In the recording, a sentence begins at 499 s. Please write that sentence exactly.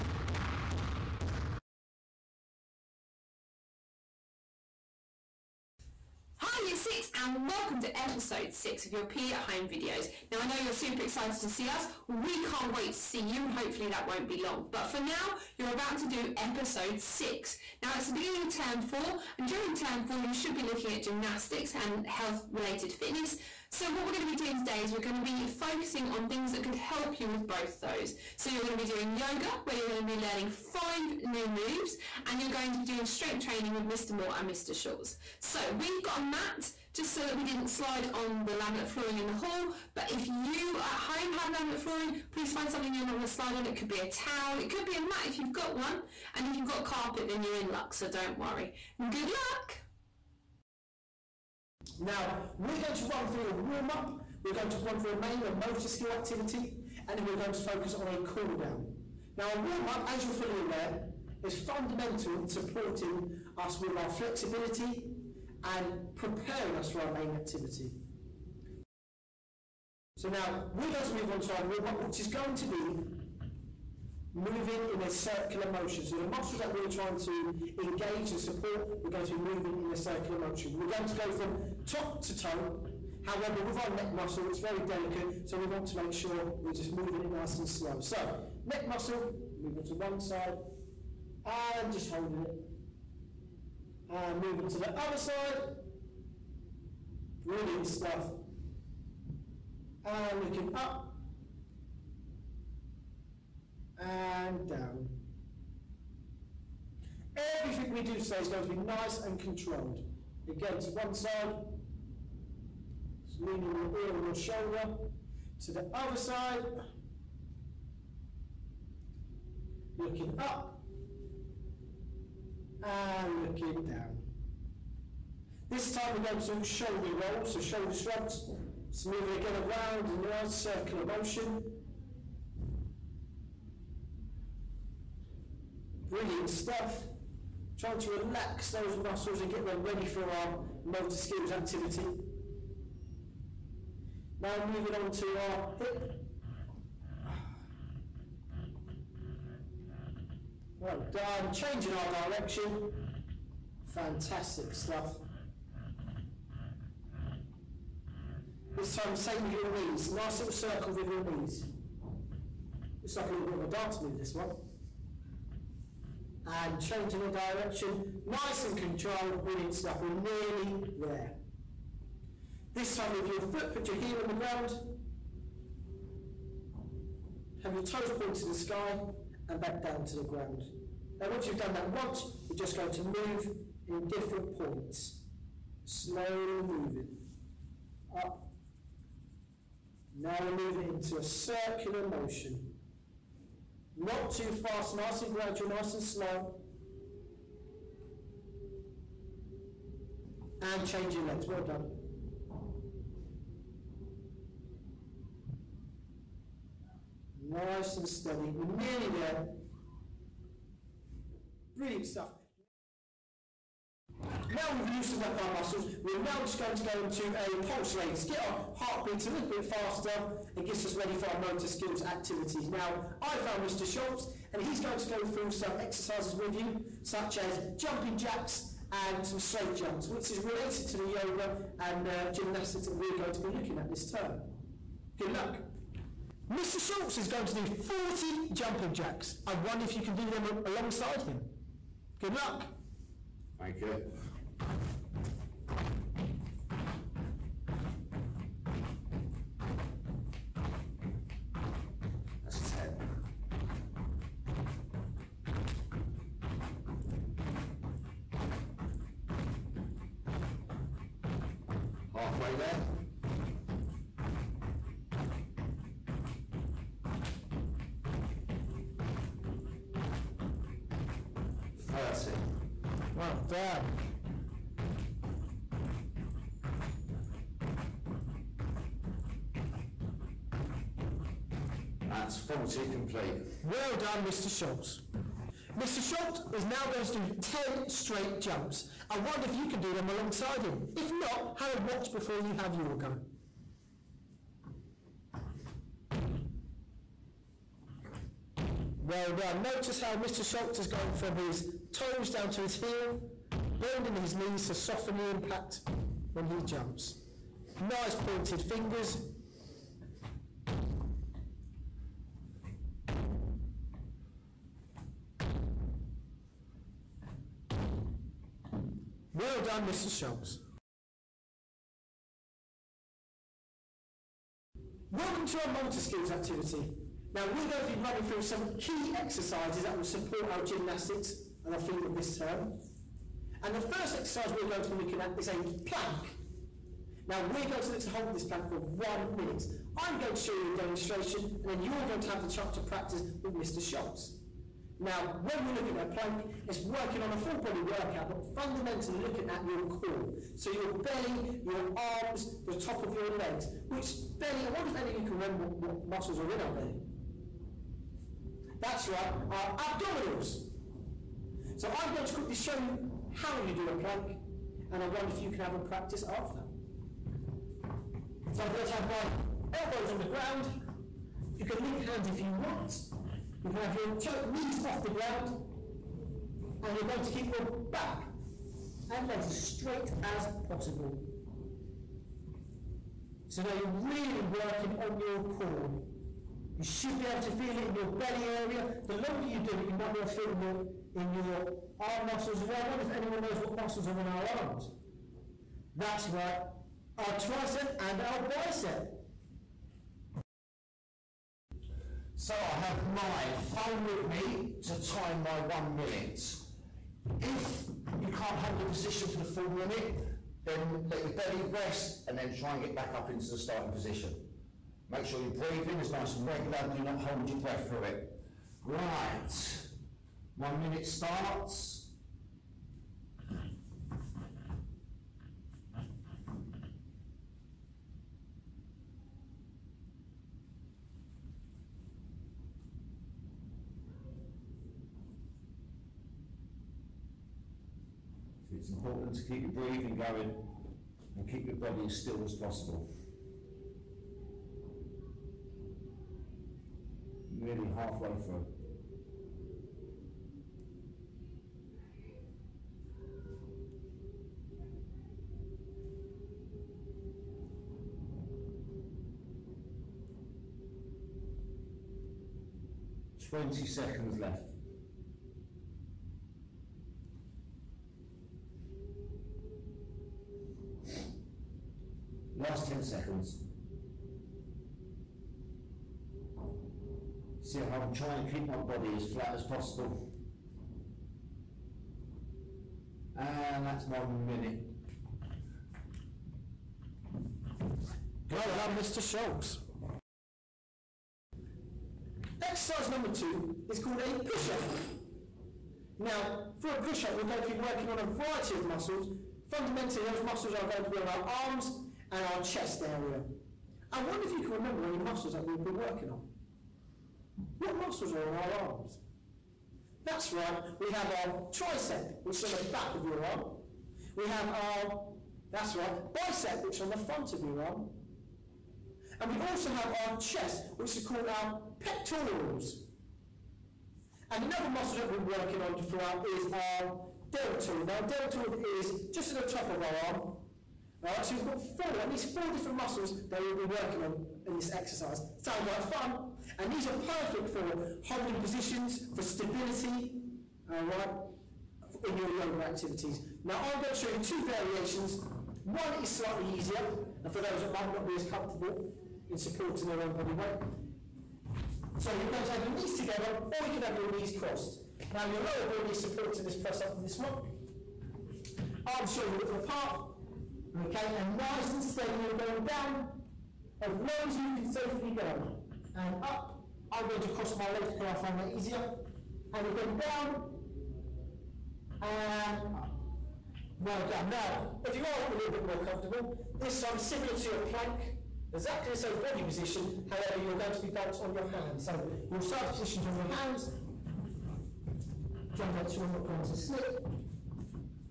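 Fundamentally, those muscles are going to be on our arms and our chest area.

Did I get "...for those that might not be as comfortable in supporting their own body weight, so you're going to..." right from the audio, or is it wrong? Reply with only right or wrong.
right.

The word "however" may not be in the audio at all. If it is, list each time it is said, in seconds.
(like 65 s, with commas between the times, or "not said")
83 s, 580 s.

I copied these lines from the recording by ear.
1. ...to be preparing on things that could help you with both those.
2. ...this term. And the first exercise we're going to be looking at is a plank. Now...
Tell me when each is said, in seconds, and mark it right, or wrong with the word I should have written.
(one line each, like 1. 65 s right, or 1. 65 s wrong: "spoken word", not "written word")
1. 25 s wrong: "focusing", not "preparing"
2. 332 s right.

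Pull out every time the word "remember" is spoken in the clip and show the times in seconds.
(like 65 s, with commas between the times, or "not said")
355 s, 504 s.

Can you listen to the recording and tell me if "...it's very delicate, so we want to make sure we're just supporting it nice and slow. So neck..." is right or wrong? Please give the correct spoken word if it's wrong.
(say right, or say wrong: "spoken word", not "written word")
wrong: "moving", not "supporting".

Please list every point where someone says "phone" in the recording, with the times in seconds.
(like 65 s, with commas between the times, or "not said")
403 s.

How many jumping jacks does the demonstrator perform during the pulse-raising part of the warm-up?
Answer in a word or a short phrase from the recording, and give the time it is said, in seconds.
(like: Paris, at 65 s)
40, at 237 s.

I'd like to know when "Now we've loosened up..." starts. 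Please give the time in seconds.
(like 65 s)
214 s.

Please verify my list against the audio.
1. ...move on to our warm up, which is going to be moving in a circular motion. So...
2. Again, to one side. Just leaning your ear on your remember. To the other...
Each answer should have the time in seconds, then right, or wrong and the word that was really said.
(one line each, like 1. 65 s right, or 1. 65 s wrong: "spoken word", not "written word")
1. 71 s right
2. 110 s wrong: "shoulder", not "remember".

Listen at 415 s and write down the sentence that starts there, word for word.
Make sure your breathing is nice and regular, do not hold your breath through it.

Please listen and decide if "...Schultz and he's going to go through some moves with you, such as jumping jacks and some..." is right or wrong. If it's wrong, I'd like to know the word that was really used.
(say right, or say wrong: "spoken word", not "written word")
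wrong: "exercises", not "moves".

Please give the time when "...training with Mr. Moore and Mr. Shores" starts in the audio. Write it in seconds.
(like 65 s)
33 s.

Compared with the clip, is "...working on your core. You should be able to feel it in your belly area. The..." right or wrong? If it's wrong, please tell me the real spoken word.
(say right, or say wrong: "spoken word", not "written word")
right.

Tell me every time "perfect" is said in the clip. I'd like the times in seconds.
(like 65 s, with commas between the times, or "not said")
537 s.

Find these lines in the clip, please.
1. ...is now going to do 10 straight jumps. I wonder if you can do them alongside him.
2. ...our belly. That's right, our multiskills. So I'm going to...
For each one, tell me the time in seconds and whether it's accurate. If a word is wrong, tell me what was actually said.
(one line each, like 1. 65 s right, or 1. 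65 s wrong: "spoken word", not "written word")
1. 286 s right
2. 356 s wrong: "abdominals", not "multiskills".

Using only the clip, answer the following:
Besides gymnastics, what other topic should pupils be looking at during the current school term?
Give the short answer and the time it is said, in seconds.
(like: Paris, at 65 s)
health related fitness, at 22 s.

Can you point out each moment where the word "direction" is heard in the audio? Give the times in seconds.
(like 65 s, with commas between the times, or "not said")
152 s, 167 s.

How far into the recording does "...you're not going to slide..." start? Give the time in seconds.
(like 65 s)
42 s.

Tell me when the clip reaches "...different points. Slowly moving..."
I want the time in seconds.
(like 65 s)
184 s.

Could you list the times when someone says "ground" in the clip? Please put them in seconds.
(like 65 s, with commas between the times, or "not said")
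174 s, 180 s, 370 s, 375 s.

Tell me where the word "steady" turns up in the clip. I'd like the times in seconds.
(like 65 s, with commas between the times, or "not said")
208 s, 562 s.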